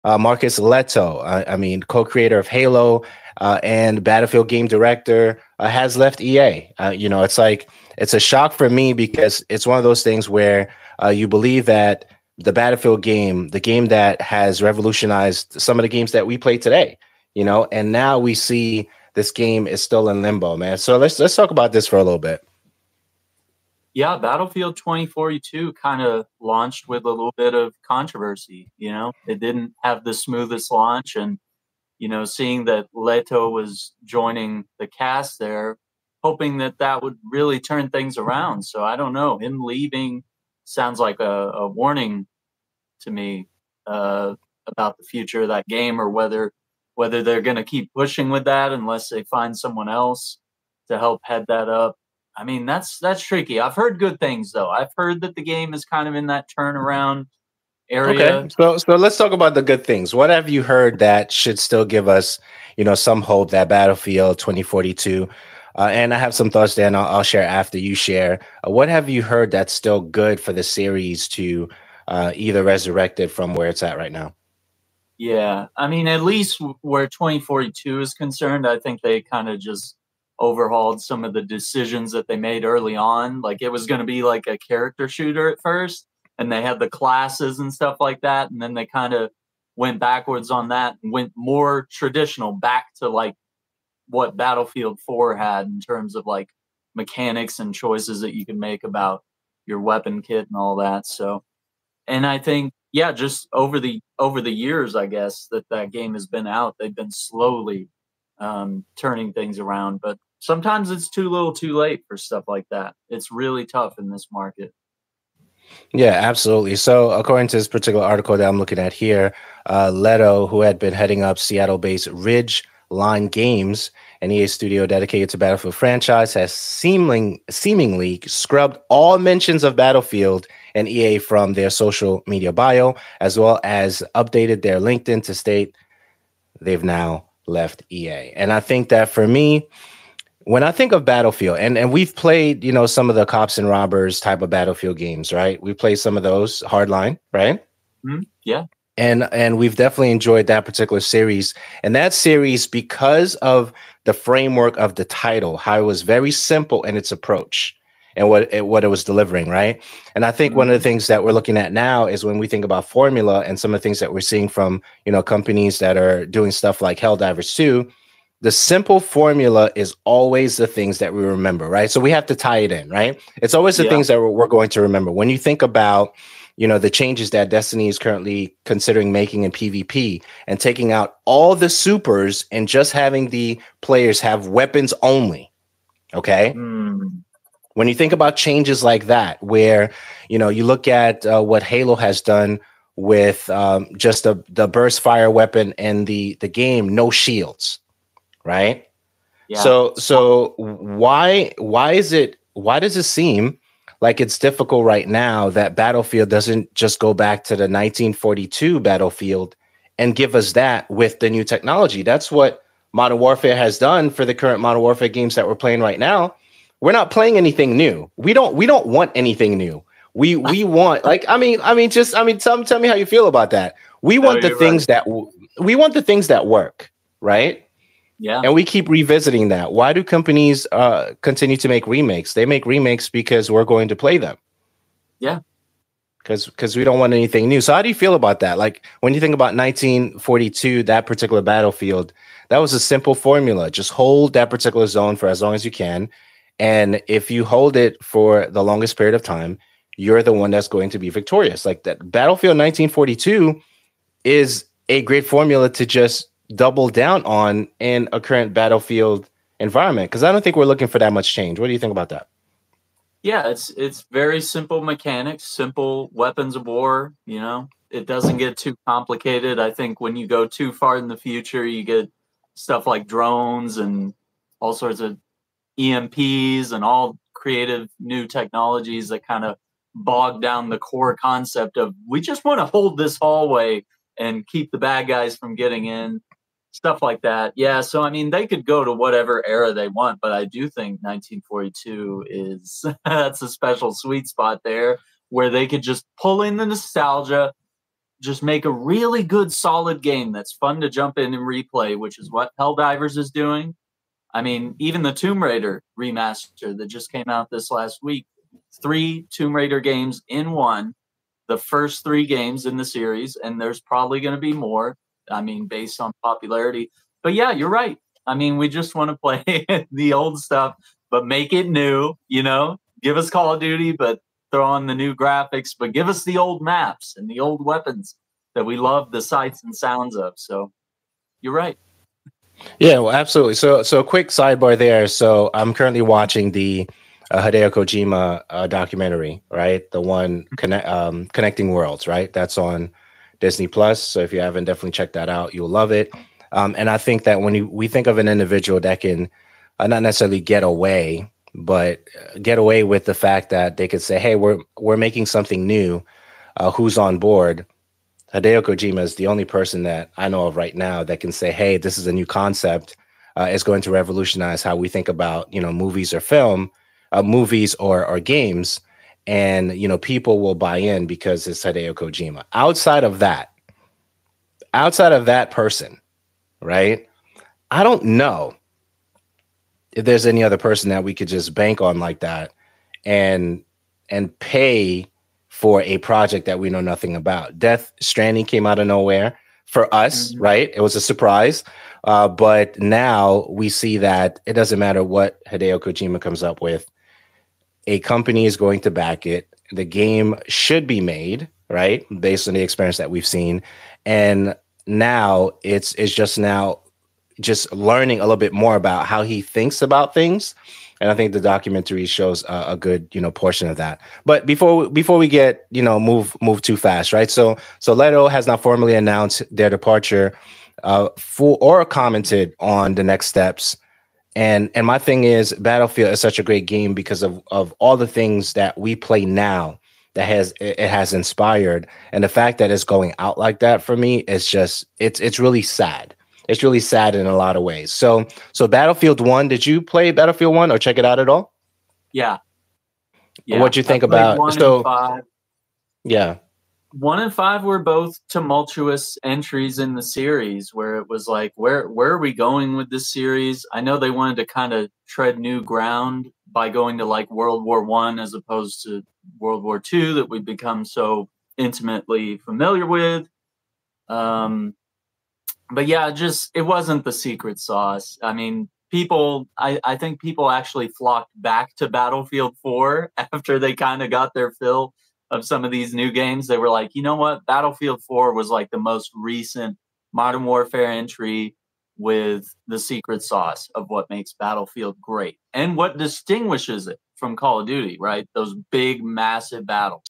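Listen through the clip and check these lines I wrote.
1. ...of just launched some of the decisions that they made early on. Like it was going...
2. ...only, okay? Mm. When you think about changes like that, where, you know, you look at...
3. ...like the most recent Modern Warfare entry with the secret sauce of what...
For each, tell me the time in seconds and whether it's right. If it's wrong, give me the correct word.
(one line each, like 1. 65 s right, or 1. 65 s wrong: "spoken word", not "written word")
1. 79 s wrong: "overhauled", not "launched"
2. 185 s right
3. 478 s right.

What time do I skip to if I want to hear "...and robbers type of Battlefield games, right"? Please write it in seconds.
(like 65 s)
143 s.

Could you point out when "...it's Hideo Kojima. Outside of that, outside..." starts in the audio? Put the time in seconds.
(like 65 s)
371 s.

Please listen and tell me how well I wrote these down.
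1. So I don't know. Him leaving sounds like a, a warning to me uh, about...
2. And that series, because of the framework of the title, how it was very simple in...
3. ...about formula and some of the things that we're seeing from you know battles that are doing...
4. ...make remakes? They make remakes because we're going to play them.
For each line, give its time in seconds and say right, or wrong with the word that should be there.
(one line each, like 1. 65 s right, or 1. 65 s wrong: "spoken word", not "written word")
1. 38 s right
2. 151 s right
3. 162 s wrong: "companies", not "battles"
4. 231 s right.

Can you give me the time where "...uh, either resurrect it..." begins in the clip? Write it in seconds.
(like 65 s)
72 s.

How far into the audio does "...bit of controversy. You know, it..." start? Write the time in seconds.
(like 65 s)
27 s.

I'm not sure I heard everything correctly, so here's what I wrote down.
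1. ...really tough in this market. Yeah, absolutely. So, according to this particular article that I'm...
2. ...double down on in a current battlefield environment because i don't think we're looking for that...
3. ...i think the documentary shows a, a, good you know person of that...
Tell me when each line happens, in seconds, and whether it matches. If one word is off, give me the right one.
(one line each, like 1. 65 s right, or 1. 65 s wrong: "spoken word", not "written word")
1. 113 s right
2. 256 s right
3. 411 s wrong: "portion", not "person".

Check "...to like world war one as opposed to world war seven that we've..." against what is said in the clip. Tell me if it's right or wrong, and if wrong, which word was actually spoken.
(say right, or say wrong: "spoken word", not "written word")
wrong: "two", not "seven".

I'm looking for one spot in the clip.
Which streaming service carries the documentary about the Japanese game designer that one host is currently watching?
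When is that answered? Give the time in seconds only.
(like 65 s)
343 s.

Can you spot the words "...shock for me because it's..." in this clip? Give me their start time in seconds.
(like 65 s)
8 s.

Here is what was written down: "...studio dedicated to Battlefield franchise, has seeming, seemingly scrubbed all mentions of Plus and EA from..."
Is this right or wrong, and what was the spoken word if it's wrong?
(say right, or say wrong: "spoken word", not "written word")
wrong: "Battlefield", not "Plus".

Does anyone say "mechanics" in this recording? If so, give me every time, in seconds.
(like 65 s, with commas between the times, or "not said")
96 s, 264 s.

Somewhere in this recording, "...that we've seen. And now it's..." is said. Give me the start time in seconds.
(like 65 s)
402 s.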